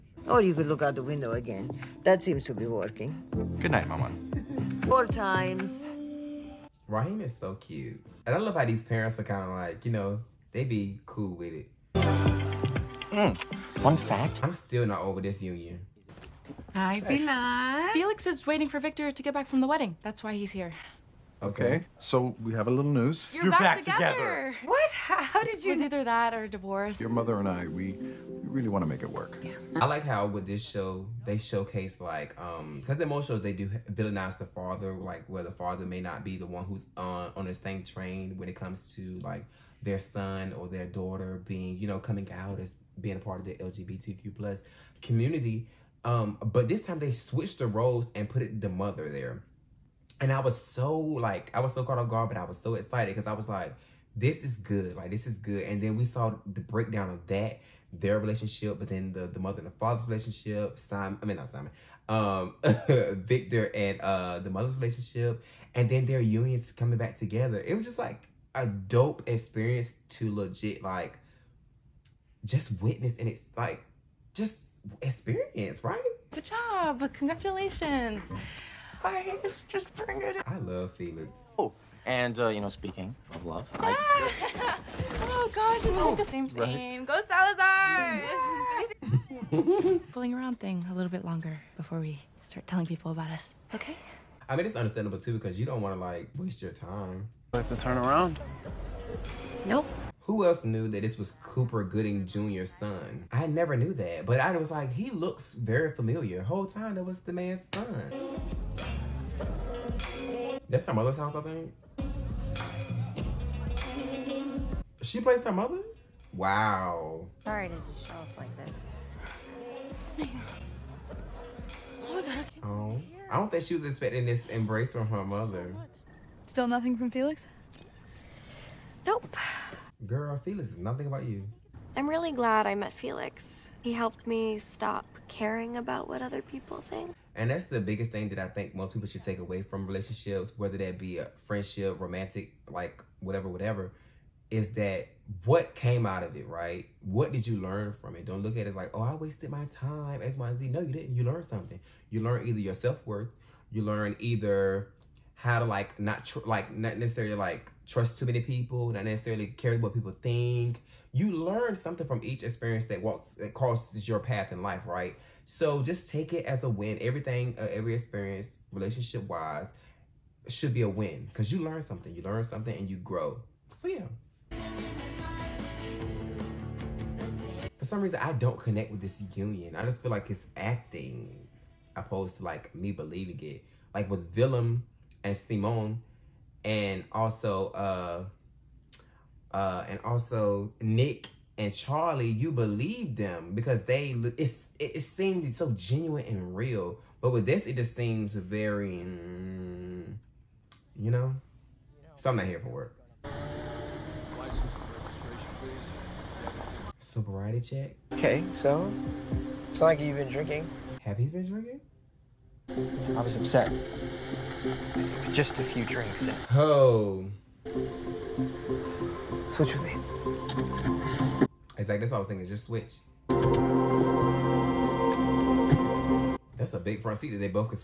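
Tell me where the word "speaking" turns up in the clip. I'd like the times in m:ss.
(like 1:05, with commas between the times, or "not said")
1:22.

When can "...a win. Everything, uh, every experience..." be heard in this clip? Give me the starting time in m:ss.
2:46.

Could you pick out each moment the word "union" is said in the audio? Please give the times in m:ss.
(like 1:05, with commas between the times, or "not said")
0:15, 1:06, 2:59.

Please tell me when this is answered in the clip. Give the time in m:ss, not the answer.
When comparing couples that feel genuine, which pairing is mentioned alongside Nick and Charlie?
3:04.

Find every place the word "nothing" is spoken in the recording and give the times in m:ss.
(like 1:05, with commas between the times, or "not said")
2:06, 2:10.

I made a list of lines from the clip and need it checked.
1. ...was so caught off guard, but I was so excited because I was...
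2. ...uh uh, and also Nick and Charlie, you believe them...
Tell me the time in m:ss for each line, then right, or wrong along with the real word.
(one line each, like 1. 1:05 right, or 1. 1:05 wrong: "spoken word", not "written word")
1. 0:51 right
2. 3:07 right.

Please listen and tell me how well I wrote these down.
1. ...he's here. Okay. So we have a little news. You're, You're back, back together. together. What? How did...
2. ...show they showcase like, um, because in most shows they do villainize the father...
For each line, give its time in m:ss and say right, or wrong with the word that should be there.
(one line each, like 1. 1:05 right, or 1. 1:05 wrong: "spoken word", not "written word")
1. 0:20 right
2. 0:30 right.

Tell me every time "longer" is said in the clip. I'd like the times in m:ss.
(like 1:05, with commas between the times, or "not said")
1:31.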